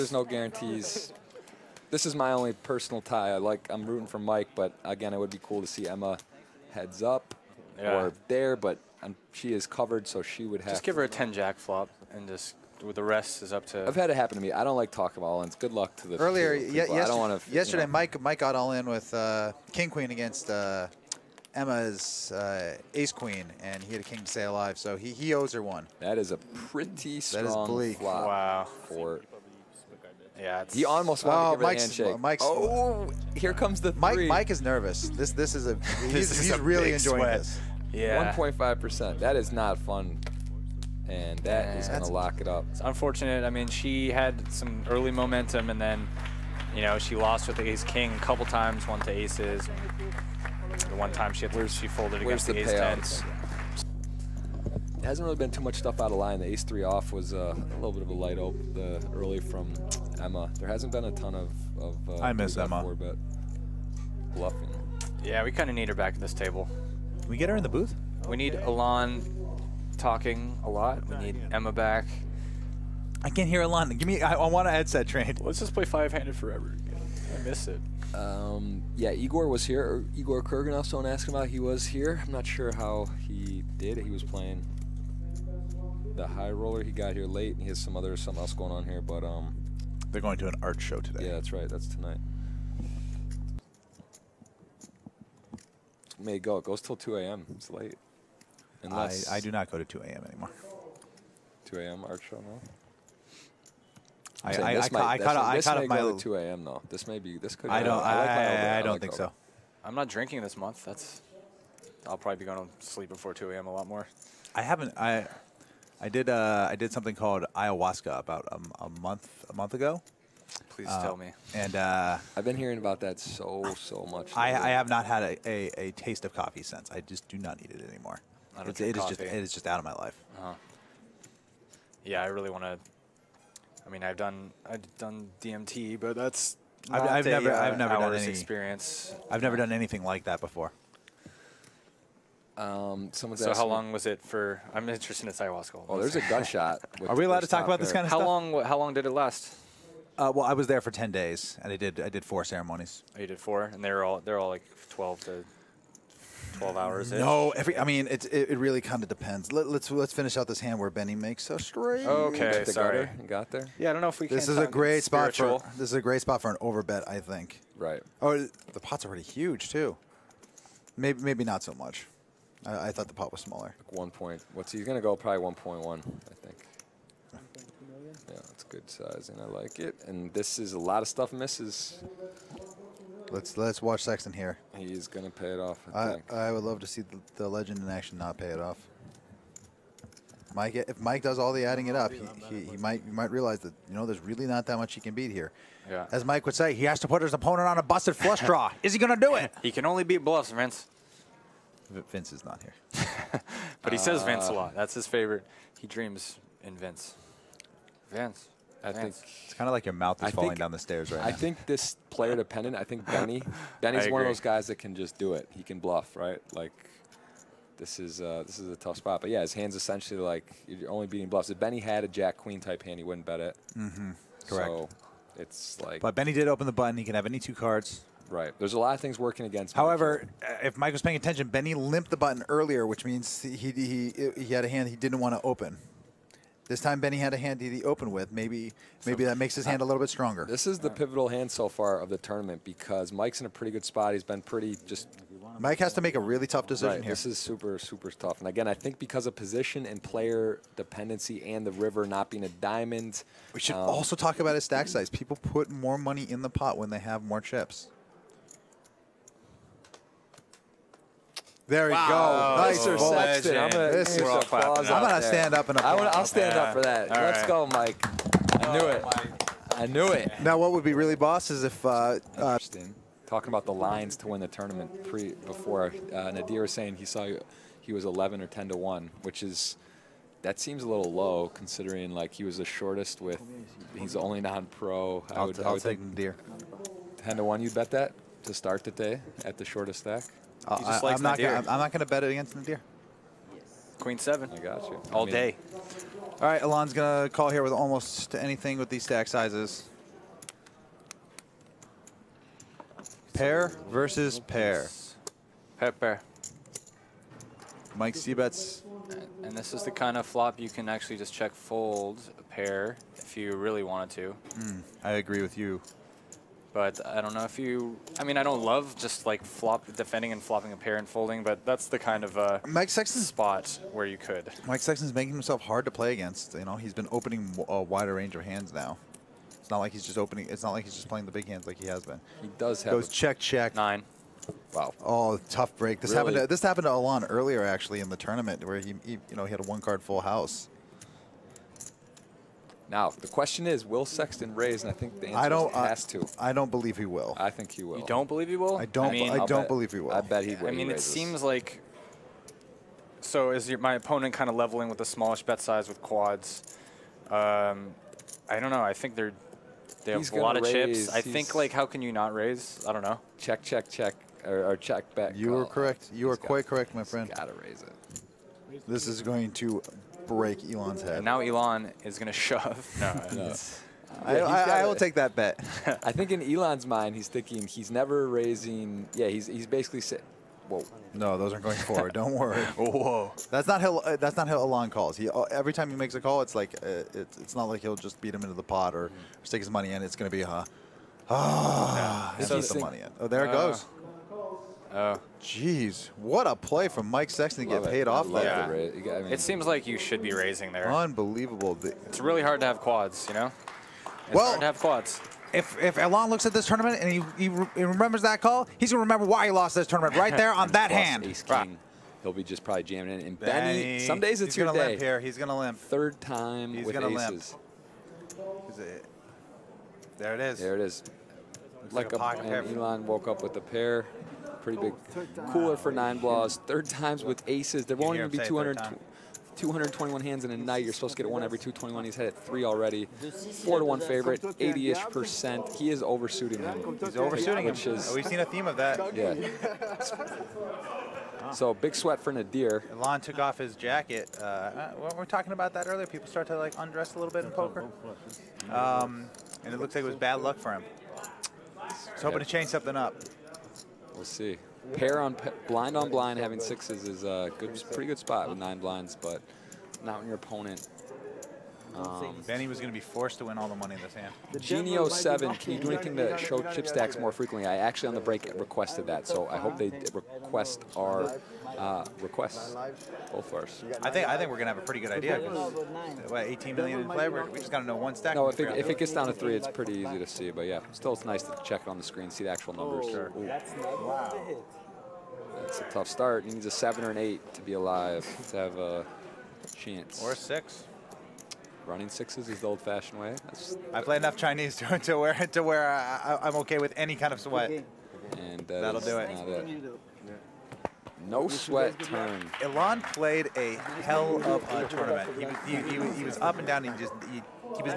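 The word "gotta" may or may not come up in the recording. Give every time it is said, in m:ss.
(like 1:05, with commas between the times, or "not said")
6:07, 7:57.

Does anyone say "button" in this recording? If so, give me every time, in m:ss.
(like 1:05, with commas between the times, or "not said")
3:46, 3:52.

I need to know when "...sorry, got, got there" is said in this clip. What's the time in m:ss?
2:42.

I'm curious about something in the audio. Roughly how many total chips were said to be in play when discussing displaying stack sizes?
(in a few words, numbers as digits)
18 million.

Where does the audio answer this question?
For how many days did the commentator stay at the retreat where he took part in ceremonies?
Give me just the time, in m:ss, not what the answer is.
2:30.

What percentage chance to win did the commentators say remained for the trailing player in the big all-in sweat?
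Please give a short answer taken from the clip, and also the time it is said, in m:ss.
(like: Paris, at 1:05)
1.5 percent, at 0:38.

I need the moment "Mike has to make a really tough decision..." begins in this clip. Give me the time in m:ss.
4:05.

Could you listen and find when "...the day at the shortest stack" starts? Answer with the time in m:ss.
4:48.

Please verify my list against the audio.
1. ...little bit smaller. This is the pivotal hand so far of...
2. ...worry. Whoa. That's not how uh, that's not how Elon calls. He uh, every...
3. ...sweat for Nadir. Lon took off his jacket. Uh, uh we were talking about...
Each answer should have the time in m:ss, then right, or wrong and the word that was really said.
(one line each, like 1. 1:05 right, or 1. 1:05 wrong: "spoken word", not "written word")
1. 3:59 wrong: "stronger", not "smaller"
2. 6:22 right
3. 7:21 right.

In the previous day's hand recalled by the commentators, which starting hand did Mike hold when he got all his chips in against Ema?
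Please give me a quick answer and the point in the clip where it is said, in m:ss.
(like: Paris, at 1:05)
King Queen, at 0:19.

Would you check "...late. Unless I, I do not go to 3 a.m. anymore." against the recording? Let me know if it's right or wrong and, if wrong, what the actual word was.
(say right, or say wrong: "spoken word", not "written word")
wrong: "2", not "3".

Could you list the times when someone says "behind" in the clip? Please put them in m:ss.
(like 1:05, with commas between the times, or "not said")
not said.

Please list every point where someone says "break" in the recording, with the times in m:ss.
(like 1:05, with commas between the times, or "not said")
5:35, 6:10, 7:48.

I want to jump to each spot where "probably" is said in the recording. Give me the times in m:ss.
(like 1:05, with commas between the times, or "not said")
1:52, 2:55, 6:52.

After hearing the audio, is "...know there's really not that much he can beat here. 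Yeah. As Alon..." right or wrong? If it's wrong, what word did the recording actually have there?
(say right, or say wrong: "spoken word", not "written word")
wrong: "Mike", not "Alon".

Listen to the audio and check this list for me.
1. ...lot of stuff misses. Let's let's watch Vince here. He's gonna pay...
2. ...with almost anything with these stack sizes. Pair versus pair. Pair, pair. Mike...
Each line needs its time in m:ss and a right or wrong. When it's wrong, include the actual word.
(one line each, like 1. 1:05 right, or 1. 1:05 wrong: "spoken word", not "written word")
1. 3:00 wrong: "Sexton", not "Vince"
2. 4:57 right.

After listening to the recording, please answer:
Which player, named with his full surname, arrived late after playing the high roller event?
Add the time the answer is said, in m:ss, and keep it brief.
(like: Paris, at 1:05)
Igor Kurganov, at 1:20.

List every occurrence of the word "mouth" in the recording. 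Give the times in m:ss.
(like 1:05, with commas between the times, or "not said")
3:29.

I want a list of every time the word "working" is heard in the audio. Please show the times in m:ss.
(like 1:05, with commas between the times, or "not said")
3:49.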